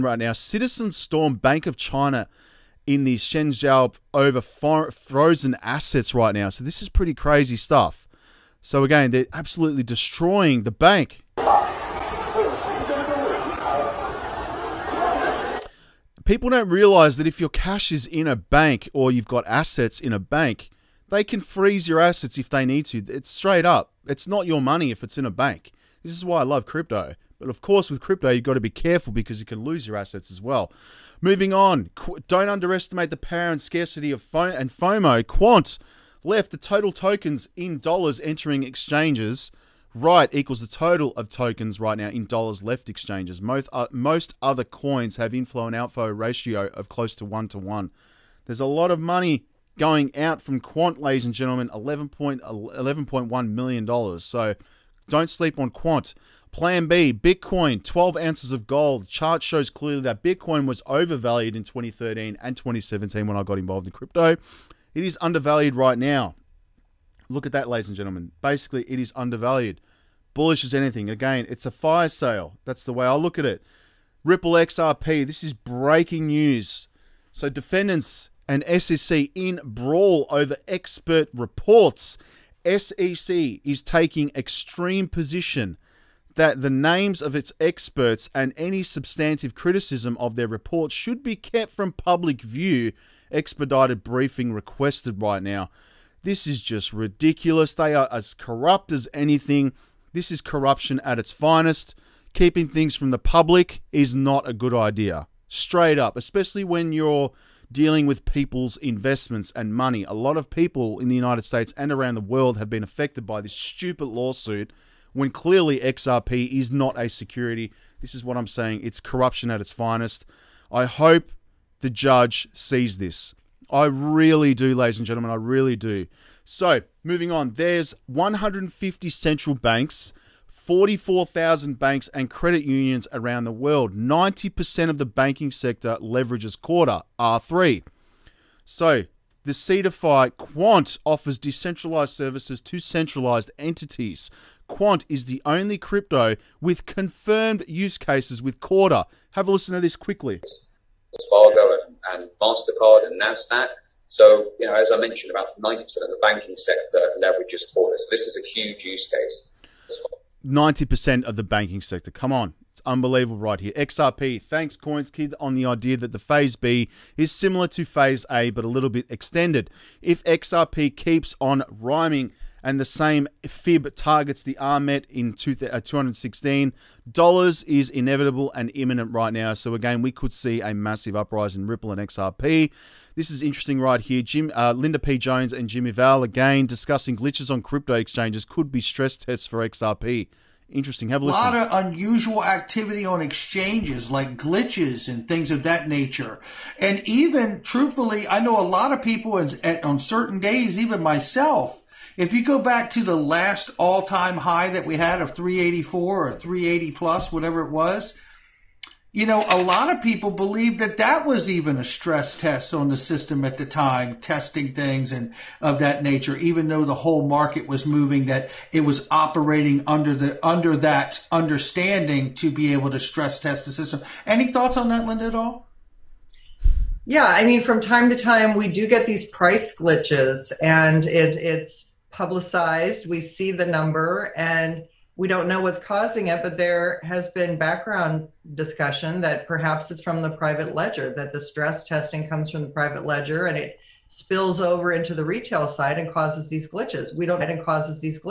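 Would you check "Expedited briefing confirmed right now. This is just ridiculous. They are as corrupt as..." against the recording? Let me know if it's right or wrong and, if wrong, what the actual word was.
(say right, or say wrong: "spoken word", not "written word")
wrong: "requested", not "confirmed".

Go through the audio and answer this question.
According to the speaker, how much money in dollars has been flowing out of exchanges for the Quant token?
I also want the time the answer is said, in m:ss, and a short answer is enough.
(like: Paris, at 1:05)
$11.1 million, at 0:51.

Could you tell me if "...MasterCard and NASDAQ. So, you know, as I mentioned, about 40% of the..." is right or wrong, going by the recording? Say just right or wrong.
wrong.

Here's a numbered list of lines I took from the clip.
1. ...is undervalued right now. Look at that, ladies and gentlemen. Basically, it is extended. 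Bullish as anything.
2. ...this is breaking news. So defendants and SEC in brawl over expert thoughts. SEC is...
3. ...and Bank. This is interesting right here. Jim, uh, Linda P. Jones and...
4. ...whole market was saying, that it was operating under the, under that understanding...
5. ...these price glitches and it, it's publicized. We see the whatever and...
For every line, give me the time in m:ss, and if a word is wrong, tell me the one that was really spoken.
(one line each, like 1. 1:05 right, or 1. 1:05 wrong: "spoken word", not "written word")
1. 1:05 wrong: "undervalued", not "extended"
2. 1:15 wrong: "reports", not "thoughts"
3. 3:01 wrong: "XRP", not "Bank"
4. 3:36 wrong: "moving", not "saying"
5. 3:49 wrong: "number", not "whatever".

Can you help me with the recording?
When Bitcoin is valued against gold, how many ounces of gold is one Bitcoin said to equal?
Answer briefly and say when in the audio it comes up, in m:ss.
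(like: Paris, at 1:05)
12 ounces, at 0:57.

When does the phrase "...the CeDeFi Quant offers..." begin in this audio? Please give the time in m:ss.
2:19.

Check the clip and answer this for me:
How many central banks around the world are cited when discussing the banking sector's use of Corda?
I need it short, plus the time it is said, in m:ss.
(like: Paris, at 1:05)
150, at 2:08.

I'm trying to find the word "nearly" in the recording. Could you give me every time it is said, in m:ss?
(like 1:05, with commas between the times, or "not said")
not said.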